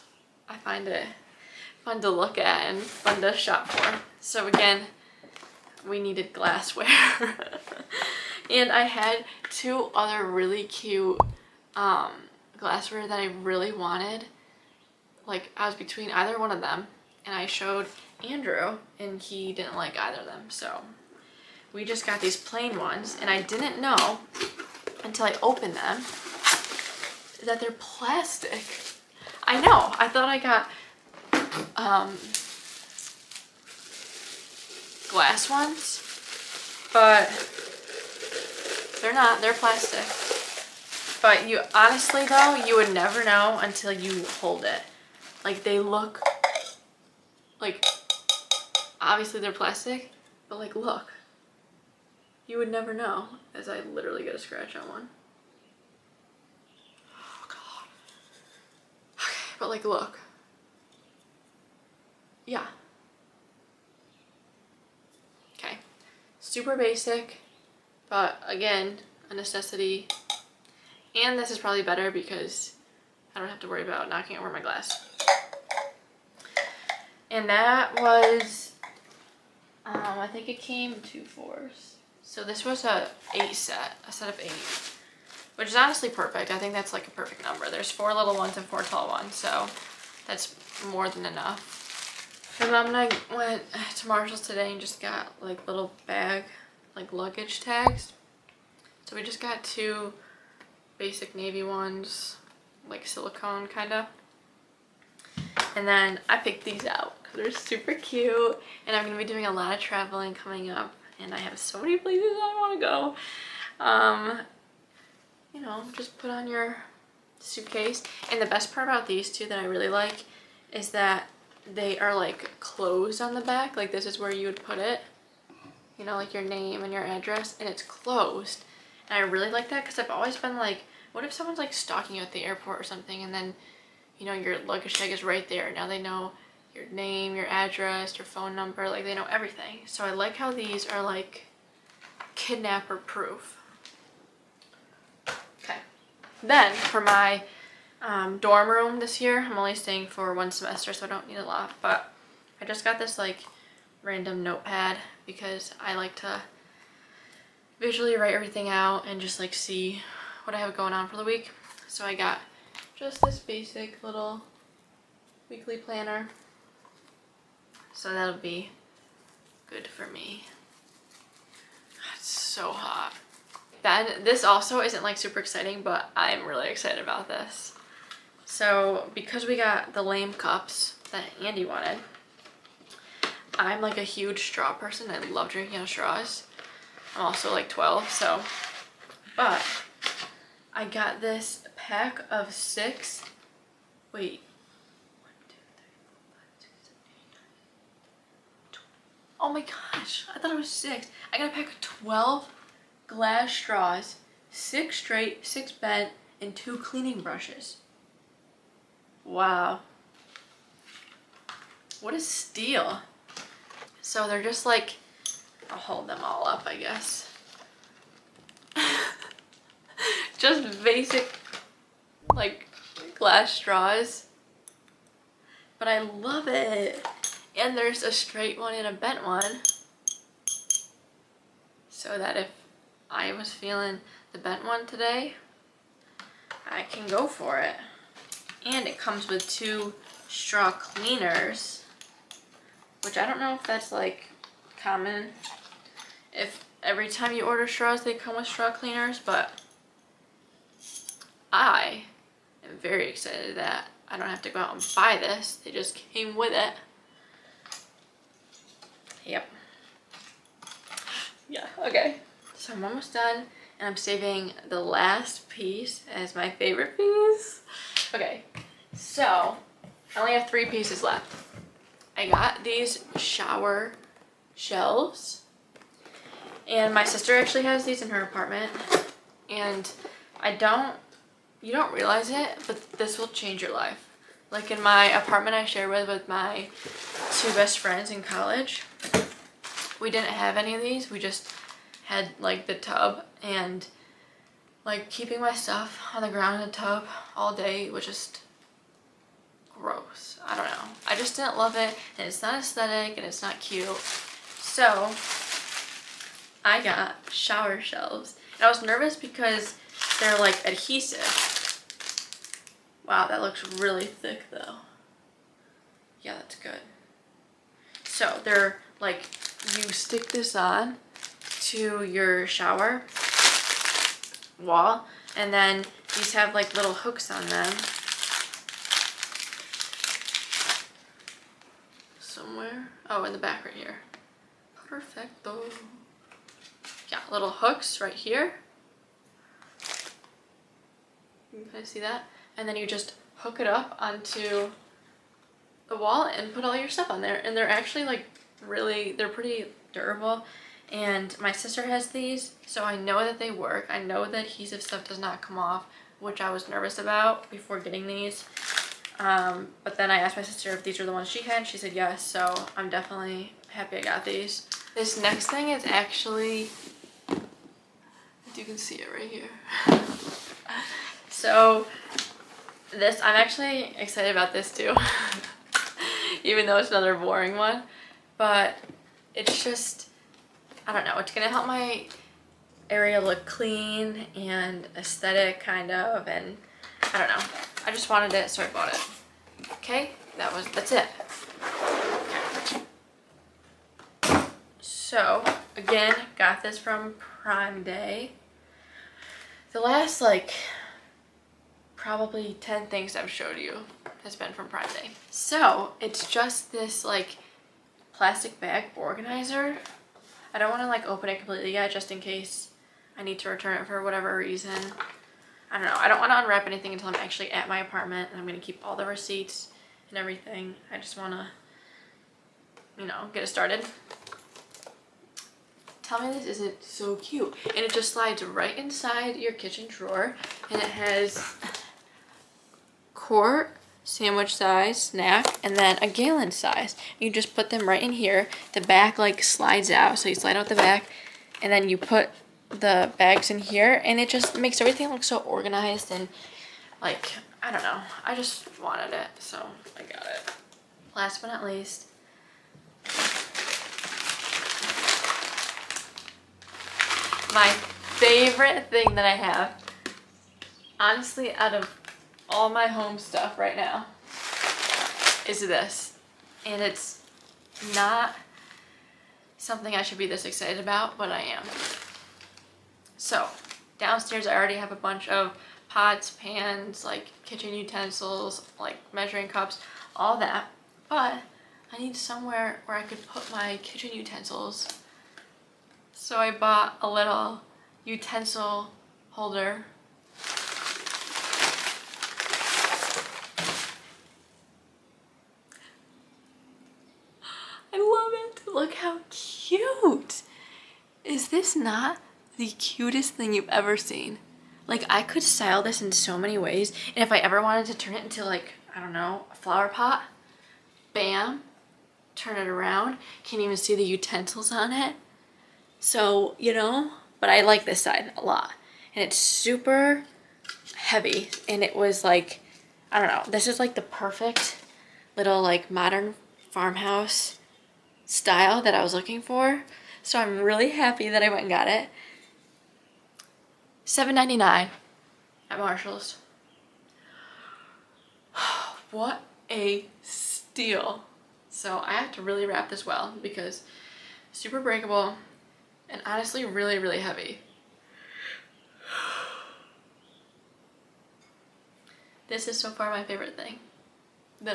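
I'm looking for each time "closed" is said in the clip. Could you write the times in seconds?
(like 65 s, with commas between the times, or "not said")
122 s, 127 s.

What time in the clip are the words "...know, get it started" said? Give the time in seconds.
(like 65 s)
423 s.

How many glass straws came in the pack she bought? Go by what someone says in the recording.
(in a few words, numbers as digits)
12.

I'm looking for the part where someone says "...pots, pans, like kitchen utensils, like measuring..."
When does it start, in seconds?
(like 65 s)
475 s.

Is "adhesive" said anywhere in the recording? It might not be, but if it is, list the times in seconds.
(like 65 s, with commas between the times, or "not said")
310 s, 354 s.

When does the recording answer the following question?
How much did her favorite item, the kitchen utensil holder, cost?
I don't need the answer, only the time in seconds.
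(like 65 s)
534 s.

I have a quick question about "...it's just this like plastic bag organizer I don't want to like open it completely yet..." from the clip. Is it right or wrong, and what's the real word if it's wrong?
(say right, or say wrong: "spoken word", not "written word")
right.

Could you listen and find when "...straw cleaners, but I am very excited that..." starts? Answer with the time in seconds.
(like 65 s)
248 s.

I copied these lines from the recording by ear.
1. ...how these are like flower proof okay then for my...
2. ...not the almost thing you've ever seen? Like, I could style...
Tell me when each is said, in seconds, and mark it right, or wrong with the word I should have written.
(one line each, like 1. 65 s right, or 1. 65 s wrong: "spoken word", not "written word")
1. 140 s wrong: "kidnapper", not "flower"
2. 501 s wrong: "cutest", not "almost".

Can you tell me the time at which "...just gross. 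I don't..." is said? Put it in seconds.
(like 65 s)
298 s.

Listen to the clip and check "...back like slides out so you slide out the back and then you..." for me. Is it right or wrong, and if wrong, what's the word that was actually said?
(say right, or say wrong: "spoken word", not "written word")
right.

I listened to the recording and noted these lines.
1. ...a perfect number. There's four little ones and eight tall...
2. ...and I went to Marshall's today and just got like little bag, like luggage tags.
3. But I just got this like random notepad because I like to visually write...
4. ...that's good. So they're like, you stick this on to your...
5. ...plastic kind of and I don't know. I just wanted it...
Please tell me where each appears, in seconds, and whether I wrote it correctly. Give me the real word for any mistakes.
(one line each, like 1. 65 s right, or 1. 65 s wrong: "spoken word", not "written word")
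1. 87 s wrong: "four", not "eight"
2. 92 s right
3. 151 s right
4. 316 s right
5. 384 s wrong: "aesthetic", not "plastic".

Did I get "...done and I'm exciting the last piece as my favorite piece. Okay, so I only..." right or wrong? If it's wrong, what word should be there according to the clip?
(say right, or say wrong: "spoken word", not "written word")
wrong: "saving", not "exciting".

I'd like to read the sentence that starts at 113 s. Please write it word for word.
Um, you know, just put on your suitcase.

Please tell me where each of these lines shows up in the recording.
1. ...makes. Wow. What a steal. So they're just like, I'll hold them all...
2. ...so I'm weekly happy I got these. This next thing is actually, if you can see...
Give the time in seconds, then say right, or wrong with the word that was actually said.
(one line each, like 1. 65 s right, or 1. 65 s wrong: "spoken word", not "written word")
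1. 207 s wrong: "brushes", not "makes"
2. 362 s wrong: "definitely", not "weekly".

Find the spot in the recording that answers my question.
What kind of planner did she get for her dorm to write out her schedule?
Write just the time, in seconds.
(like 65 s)
165 s.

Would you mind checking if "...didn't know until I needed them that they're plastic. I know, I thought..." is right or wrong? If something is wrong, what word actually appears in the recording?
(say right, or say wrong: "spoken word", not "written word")
wrong: "opened", not "needed".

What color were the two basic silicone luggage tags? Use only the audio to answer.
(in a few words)
navy.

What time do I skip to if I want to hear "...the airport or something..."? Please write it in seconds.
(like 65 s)
132 s.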